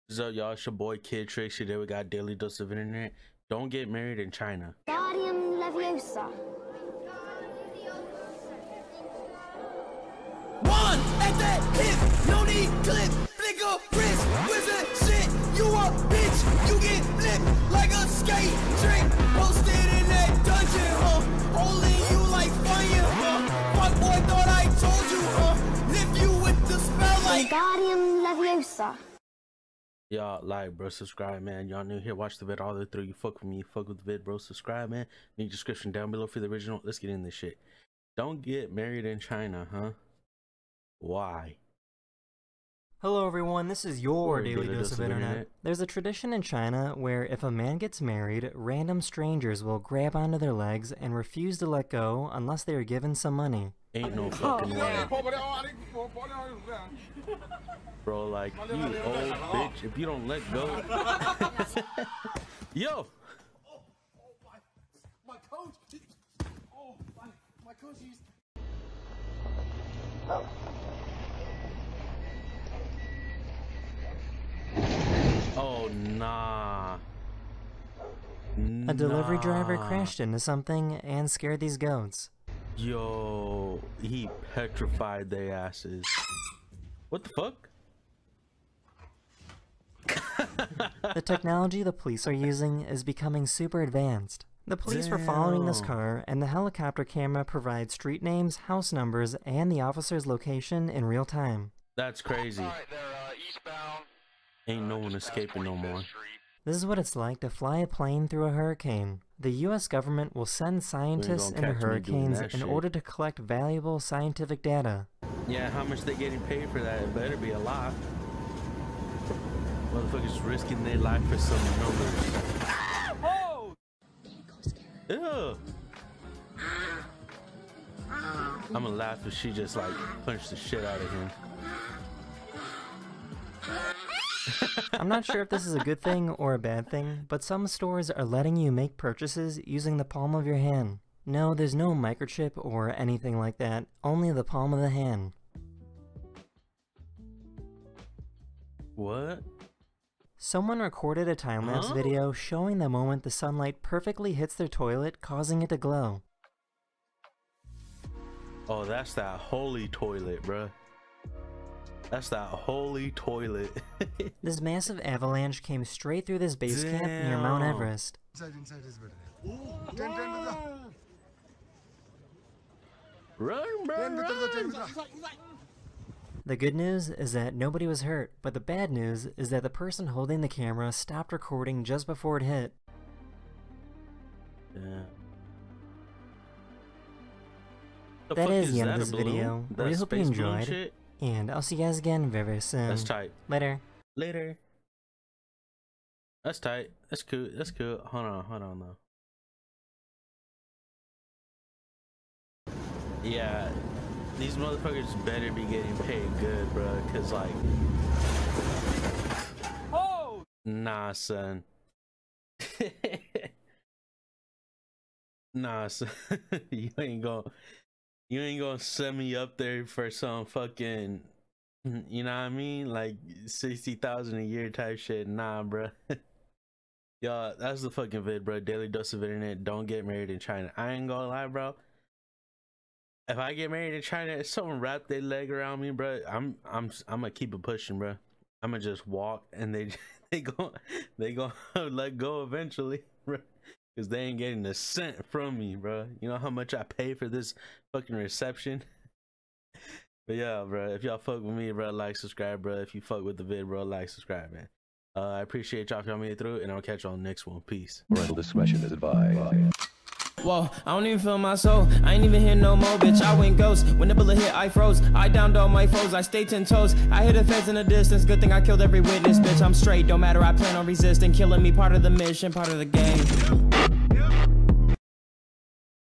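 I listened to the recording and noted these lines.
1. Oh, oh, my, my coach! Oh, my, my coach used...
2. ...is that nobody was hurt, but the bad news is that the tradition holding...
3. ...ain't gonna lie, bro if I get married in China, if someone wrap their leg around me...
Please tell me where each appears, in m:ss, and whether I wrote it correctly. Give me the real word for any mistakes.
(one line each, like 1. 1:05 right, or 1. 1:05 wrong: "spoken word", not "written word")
1. 1:03 right
2. 2:57 wrong: "person", not "tradition"
3. 3:50 right.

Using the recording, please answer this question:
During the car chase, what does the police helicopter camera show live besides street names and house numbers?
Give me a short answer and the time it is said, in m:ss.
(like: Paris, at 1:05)
the officer's location, at 1:39.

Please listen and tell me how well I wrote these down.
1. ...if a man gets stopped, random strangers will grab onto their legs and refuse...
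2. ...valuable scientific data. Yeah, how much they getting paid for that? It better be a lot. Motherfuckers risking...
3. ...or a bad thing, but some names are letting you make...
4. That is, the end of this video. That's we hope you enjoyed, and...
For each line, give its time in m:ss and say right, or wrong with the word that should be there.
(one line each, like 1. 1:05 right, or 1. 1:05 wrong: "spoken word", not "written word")
1. 0:47 wrong: "married", not "stopped"
2. 1:53 right
3. 2:16 wrong: "stores", not "names"
4. 3:08 right.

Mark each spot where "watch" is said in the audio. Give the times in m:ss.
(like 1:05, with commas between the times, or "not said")
0:32.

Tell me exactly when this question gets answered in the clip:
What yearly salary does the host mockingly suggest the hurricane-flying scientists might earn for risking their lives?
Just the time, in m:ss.
3:43.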